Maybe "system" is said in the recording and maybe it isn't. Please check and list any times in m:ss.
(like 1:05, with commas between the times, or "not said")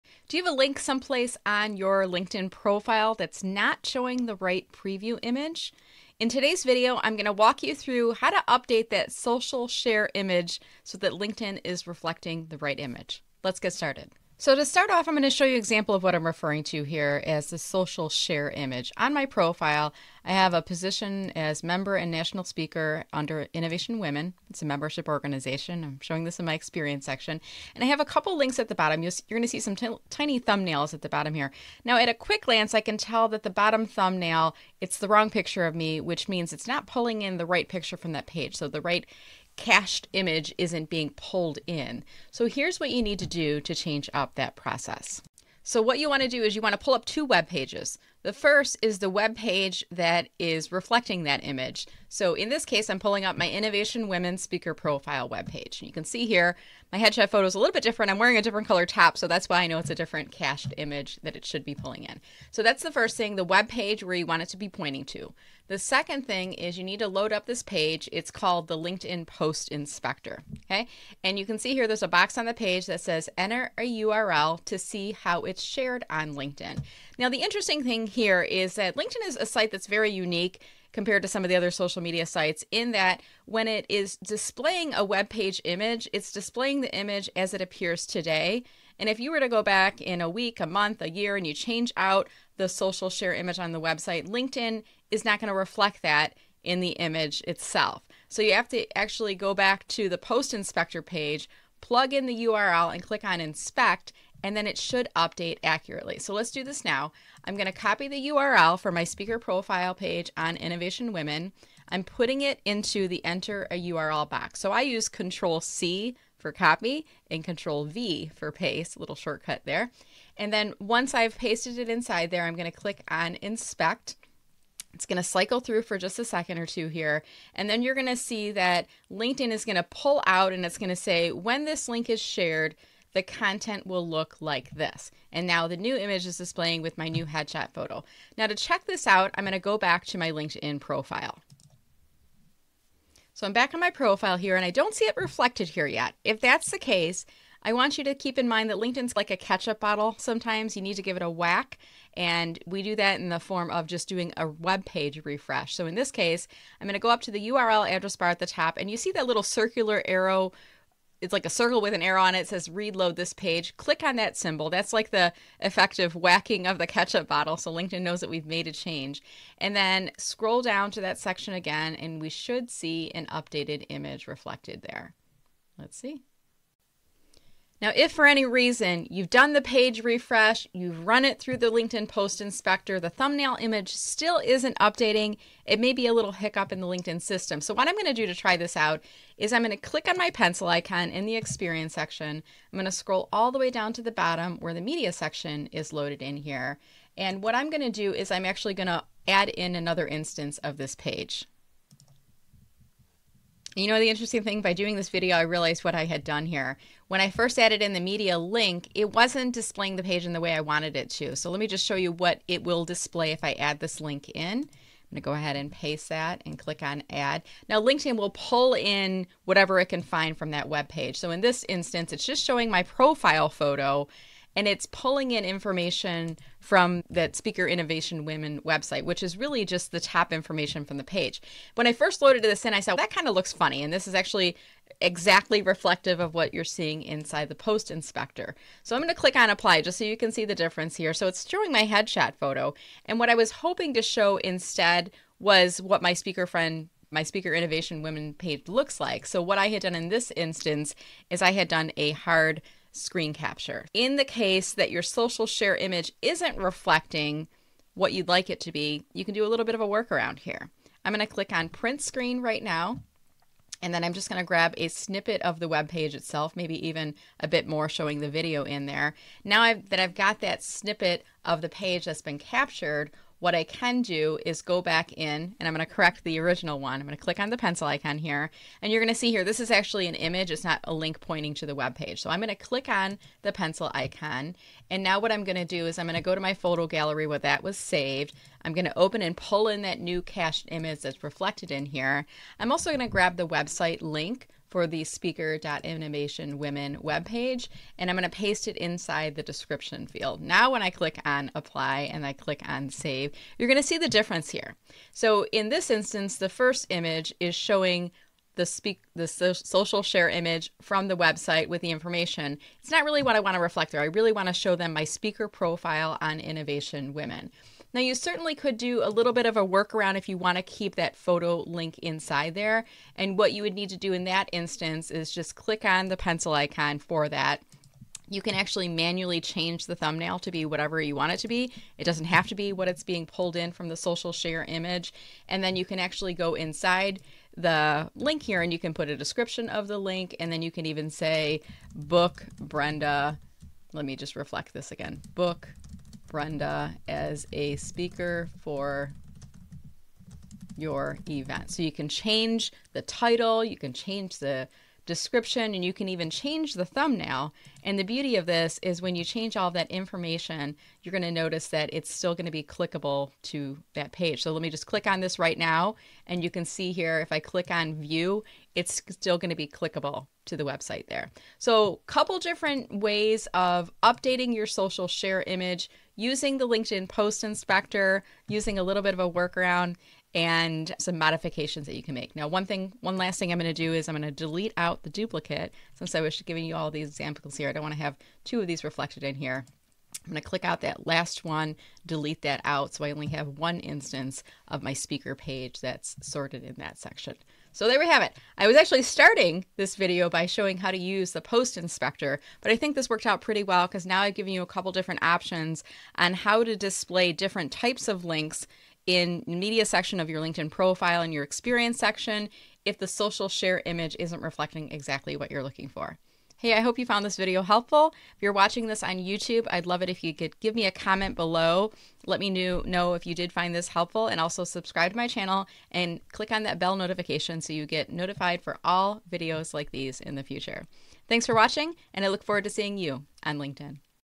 3:07.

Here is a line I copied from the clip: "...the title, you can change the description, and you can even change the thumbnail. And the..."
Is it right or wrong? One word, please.
right.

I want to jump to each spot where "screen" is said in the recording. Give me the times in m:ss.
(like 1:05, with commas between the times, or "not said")
4:12, 4:22.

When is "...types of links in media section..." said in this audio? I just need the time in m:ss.
6:47.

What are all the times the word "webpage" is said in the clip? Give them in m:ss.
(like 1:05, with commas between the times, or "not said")
0:55, 4:57.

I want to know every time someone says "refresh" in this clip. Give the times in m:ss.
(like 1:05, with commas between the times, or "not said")
2:35, 3:00.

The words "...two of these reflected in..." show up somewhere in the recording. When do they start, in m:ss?
6:28.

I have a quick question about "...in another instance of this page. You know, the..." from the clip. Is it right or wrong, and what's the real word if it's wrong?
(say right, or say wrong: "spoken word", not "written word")
right.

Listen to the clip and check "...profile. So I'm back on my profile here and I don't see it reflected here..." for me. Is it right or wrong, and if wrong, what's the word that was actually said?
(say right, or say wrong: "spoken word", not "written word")
right.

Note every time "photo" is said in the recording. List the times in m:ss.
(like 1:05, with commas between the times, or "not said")
0:57, 2:17, 3:43, 4:02, 4:46, 5:21.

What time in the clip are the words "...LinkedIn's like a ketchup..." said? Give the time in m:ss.
2:28.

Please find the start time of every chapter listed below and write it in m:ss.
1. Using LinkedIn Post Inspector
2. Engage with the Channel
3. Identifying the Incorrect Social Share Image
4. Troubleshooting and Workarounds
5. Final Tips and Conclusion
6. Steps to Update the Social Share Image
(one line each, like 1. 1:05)
1. 1:08
2. 6:56
3. 0:14
4. 2:57
5. 6:11
6. 0:42.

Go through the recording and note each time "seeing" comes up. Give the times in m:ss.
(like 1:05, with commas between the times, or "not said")
3:56, 7:12.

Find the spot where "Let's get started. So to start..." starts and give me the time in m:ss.
0:13.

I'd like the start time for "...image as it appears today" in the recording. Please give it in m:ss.
1:26.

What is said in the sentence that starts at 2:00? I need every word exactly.
And then once I've pasted it inside there, I'm going to click on inspect.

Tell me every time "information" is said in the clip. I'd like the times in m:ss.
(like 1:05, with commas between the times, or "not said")
3:45, 3:50, 5:11, 5:59.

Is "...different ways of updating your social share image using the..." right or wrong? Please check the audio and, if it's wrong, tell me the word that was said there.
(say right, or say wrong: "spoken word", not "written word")
right.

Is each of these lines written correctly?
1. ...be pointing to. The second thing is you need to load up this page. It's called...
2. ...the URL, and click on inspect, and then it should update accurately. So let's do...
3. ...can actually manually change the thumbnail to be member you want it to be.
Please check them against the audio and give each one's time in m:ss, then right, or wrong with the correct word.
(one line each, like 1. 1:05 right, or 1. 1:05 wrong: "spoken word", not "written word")
1. 1:04 right
2. 1:42 right
3. 5:28 wrong: "whatever", not "member".